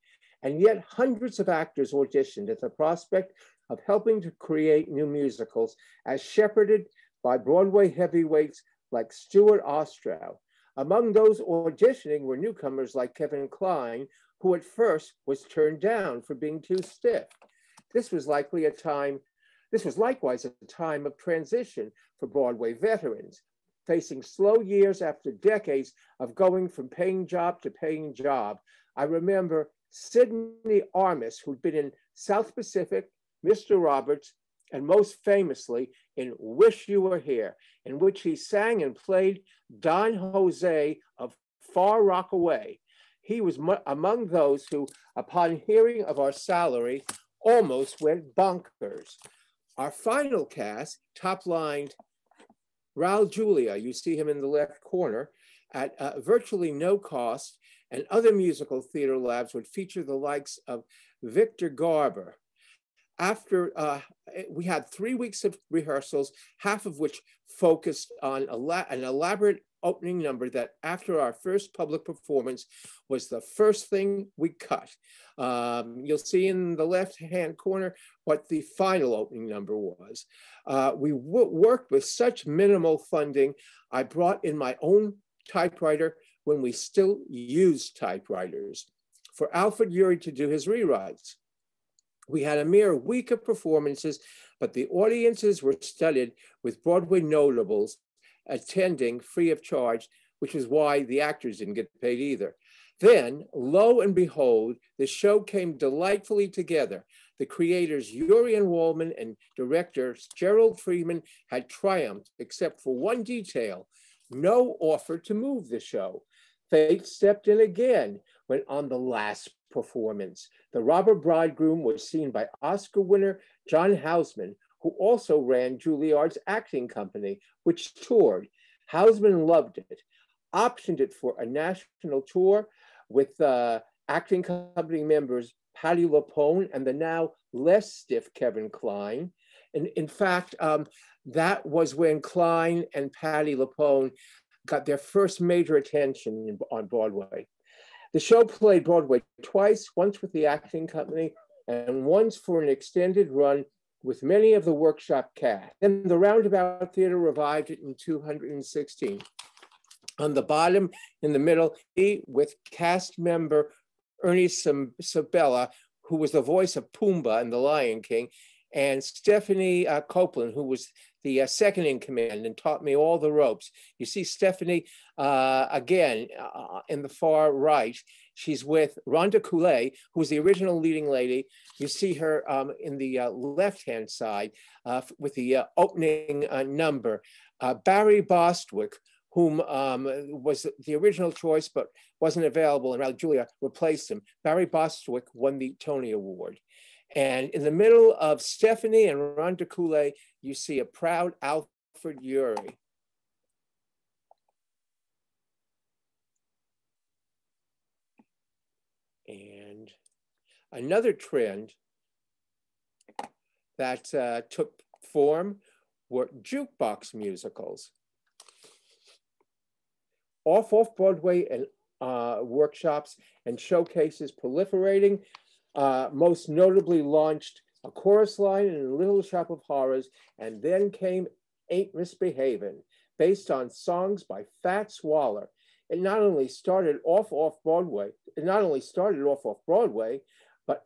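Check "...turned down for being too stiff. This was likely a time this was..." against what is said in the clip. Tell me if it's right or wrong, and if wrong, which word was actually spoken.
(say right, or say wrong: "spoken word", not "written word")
right.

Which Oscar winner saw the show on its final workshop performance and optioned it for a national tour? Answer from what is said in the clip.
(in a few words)
John Houseman.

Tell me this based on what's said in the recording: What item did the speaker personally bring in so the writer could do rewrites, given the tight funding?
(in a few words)
typewriter.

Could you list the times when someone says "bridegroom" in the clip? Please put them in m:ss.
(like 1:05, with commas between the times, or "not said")
2:01.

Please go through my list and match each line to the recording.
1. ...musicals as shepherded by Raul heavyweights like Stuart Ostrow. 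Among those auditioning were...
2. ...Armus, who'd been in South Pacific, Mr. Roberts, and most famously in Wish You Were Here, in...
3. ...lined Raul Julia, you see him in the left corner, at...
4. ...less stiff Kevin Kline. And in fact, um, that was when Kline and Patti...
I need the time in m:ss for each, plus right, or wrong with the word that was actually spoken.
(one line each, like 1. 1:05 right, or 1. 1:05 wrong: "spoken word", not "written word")
1. 0:05 wrong: "Broadway", not "Raul"
2. 0:30 right
3. 0:51 right
4. 2:17 right.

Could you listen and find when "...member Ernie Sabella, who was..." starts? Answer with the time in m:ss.
2:43.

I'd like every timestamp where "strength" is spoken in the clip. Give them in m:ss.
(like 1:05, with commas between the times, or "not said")
not said.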